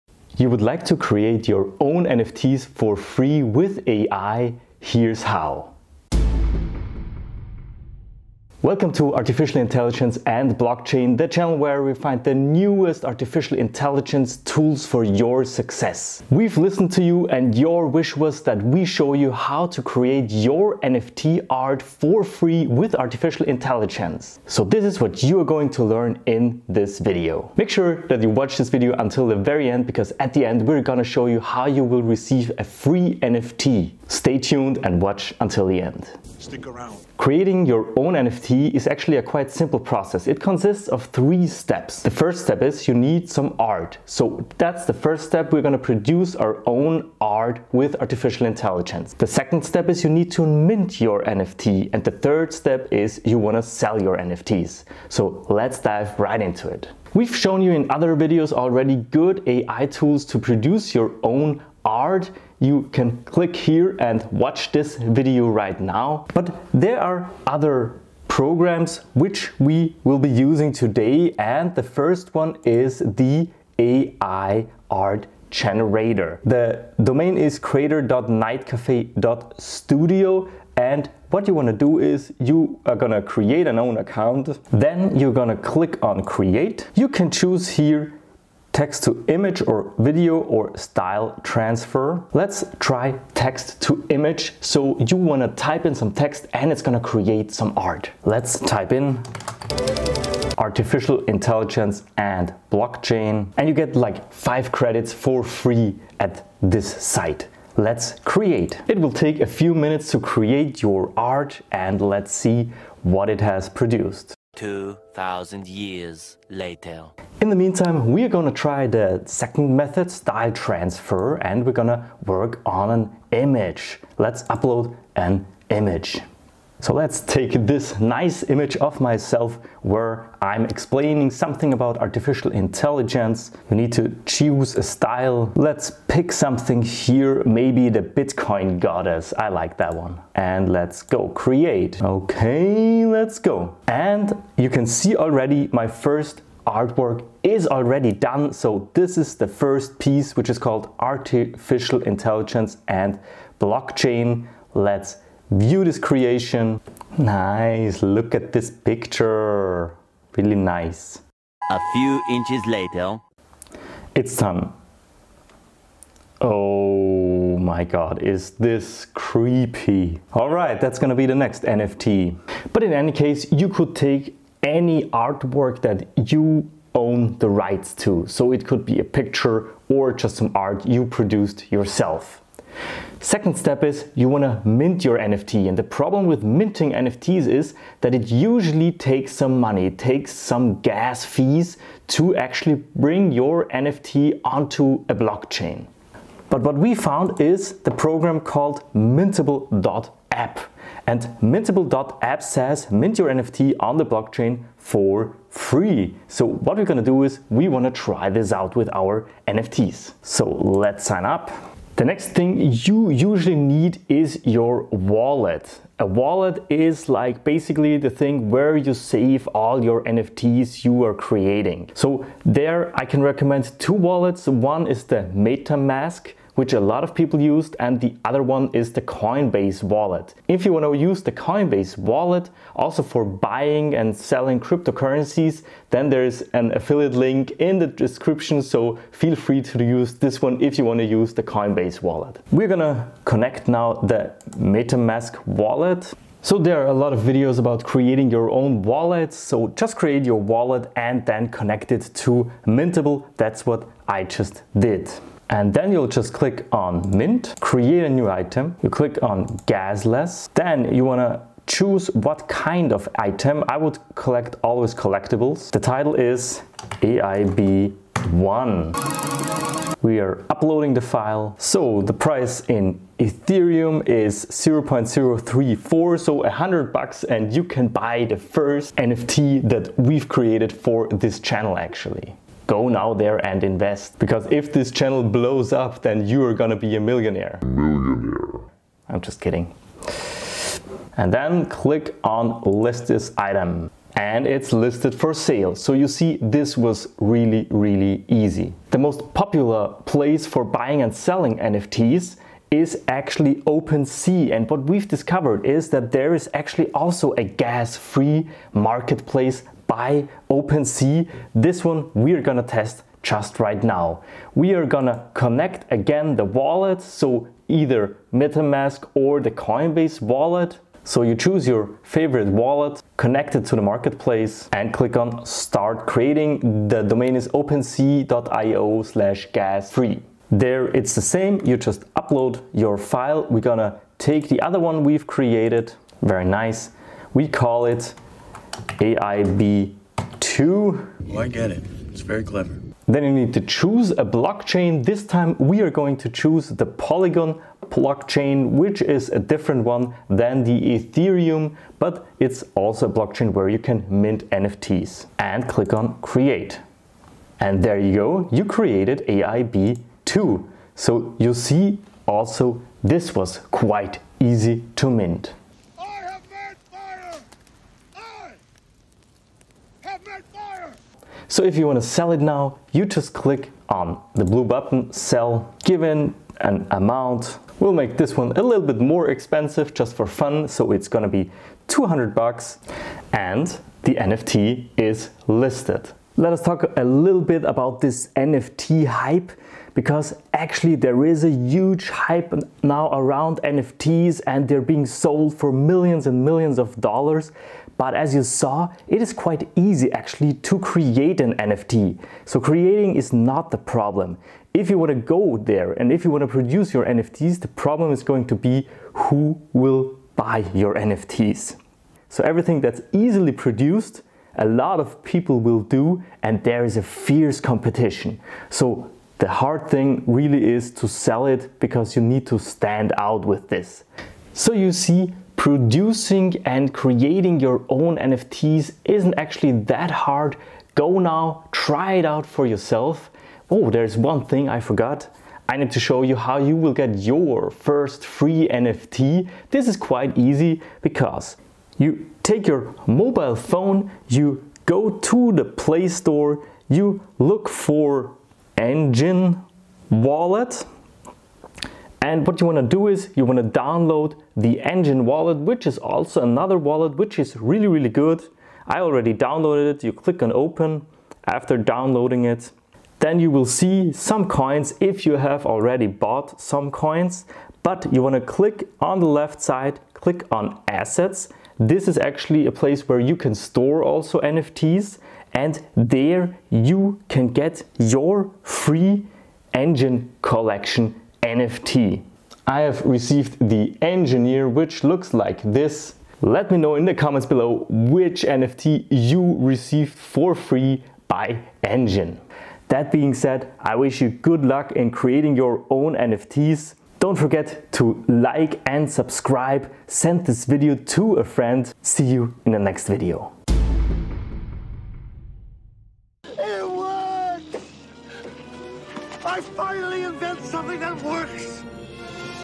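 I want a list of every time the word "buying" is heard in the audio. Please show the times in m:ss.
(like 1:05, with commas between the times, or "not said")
3:53, 5:00.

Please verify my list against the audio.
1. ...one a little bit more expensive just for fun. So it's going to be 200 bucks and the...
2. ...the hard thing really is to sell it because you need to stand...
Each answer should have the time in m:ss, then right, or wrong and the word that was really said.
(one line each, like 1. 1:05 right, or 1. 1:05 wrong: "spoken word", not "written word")
1. 6:18 right
2. 6:59 right.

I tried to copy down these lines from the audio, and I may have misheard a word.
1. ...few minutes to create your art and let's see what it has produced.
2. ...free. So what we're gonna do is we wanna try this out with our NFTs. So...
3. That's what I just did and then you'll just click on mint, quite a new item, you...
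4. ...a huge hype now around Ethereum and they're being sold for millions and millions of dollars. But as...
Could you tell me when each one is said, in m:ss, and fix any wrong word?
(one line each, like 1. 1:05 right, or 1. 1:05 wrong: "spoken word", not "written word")
1. 1:49 right
2. 3:25 right
3. 4:13 wrong: "create", not "quite"
4. 6:31 wrong: "NFTs", not "Ethereum".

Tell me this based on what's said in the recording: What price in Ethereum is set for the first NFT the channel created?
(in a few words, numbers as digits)
0.034.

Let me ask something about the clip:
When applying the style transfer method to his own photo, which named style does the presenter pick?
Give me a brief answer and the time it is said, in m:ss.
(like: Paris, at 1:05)
Bitcoin goddess, at 2:18.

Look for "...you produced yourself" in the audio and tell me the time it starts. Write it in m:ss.
3:00.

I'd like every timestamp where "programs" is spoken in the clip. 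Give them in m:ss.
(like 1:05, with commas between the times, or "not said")
1:08, 3:17.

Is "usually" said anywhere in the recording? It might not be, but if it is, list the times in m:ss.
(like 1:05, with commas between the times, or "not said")
3:08, 3:33.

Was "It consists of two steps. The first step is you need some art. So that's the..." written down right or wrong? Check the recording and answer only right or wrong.
wrong.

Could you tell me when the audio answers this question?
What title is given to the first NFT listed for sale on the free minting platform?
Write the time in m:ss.
4:27.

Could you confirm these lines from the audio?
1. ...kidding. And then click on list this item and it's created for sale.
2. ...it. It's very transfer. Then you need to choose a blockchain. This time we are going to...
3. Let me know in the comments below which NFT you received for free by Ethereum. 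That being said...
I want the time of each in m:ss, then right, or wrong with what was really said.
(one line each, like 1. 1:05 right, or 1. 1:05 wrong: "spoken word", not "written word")
1. 4:49 wrong: "listed", not "created"
2. 5:41 wrong: "clever", not "transfer"
3. 8:06 wrong: "Enjin", not "Ethereum".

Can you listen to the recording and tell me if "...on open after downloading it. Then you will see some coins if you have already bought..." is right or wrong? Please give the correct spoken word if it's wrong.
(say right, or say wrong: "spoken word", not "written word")
right.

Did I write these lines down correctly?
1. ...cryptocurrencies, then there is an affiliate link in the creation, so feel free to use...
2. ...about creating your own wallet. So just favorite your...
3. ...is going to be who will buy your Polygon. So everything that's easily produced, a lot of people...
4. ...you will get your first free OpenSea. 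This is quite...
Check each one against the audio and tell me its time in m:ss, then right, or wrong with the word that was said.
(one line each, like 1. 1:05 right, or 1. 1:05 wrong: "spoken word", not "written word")
1. 3:54 wrong: "description", not "creation"
2. 4:07 wrong: "create", not "favorite"
3. 6:48 wrong: "NFTs", not "Polygon"
4. 7:16 wrong: "NFT", not "OpenSea".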